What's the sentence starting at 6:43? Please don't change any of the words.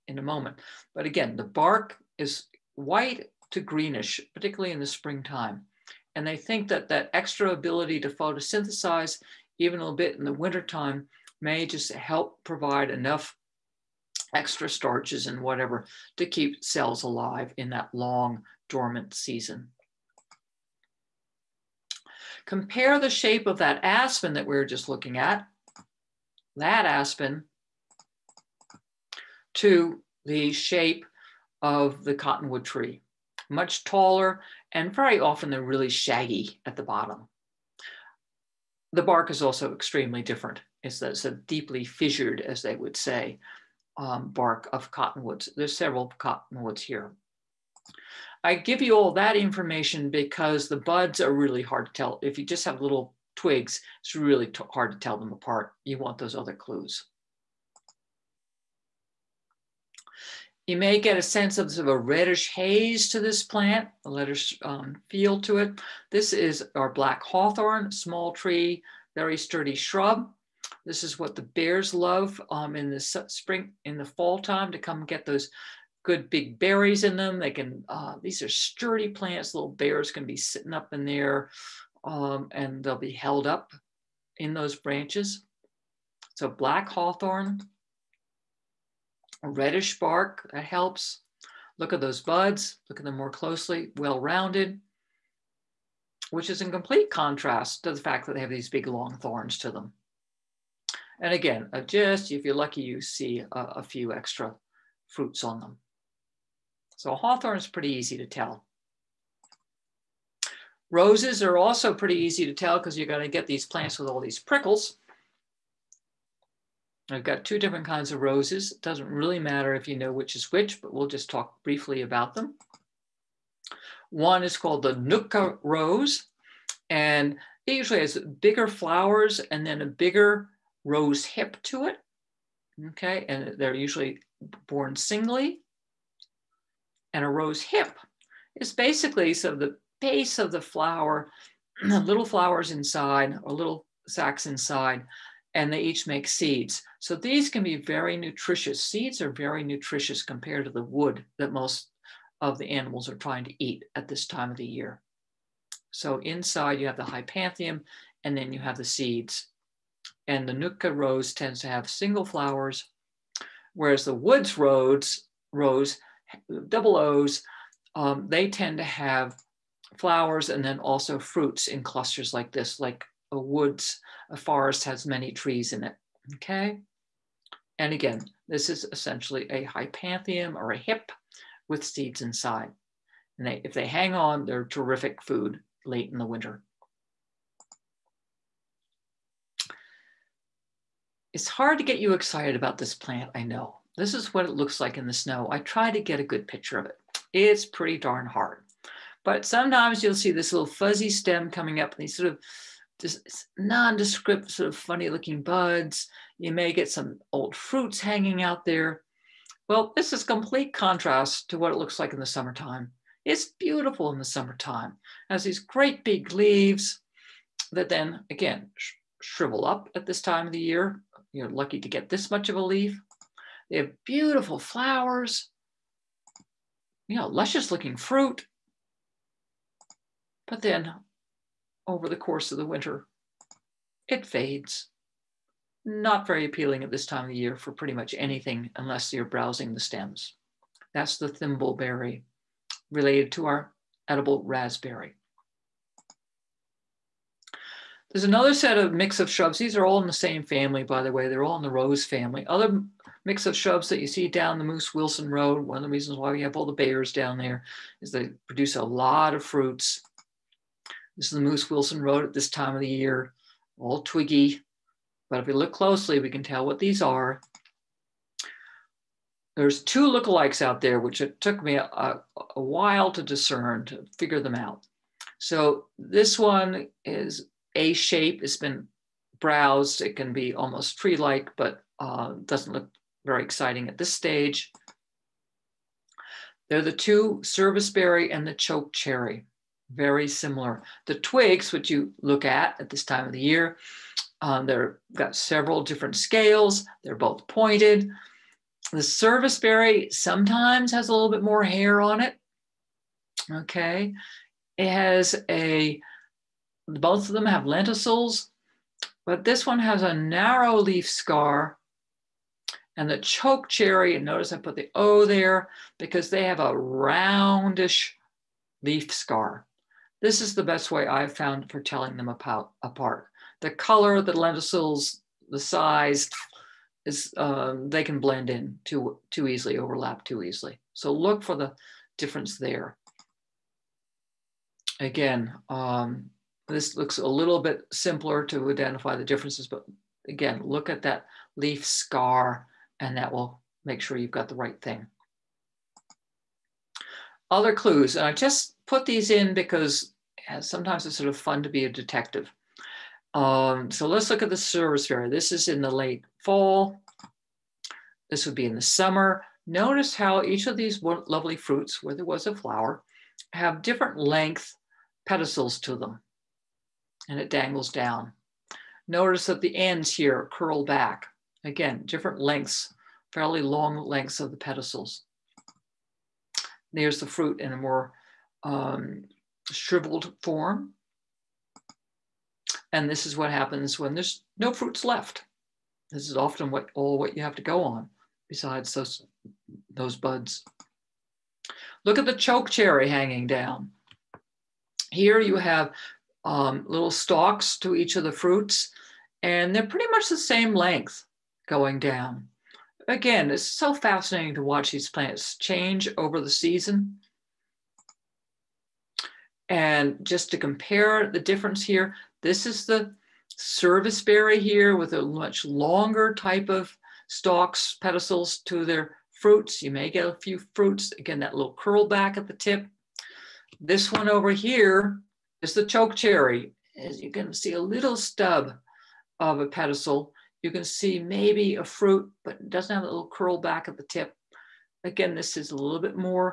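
Again, it's so fascinating to watch these plants change over the season.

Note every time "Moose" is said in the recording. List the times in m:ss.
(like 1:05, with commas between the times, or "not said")
4:14, 4:21.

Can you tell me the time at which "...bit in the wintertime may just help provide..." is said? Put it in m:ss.
0:09.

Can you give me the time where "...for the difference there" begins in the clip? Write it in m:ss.
5:31.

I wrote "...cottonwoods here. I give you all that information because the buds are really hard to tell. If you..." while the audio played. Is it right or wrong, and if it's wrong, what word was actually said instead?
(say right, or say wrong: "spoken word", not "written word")
right.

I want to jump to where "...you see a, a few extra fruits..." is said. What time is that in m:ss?
1:42.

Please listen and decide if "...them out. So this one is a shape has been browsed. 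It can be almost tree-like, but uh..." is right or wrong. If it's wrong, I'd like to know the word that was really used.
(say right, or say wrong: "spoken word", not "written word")
right.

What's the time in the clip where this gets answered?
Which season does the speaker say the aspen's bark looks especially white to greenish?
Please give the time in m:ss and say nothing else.
0:04.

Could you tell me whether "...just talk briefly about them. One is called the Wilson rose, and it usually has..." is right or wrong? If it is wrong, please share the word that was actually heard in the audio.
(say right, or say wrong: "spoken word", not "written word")
wrong: "Nootka", not "Wilson".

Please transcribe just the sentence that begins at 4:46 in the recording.
They're the two serviceberry and the choke cherry, very similar.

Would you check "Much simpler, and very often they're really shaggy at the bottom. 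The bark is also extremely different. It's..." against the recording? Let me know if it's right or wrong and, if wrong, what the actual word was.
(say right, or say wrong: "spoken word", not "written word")
wrong: "taller", not "simpler".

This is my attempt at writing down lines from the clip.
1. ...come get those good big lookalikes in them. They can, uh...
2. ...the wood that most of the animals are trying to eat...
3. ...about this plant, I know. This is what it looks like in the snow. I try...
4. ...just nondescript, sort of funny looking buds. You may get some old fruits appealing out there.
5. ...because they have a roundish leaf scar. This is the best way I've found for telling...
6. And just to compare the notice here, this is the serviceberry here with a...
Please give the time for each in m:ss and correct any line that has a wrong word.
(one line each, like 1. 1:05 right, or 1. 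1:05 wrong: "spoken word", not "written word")
1. 1:14 wrong: "berries", not "lookalikes"
2. 2:30 right
3. 3:12 right
4. 3:22 wrong: "hanging", not "appealing"
5. 5:15 right
6. 6:49 wrong: "difference", not "notice".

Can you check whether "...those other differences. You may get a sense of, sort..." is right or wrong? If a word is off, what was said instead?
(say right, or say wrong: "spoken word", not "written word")
wrong: "clues", not "differences".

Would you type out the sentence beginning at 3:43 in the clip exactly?
They have beautiful flowers, you know, luscious looking fruit.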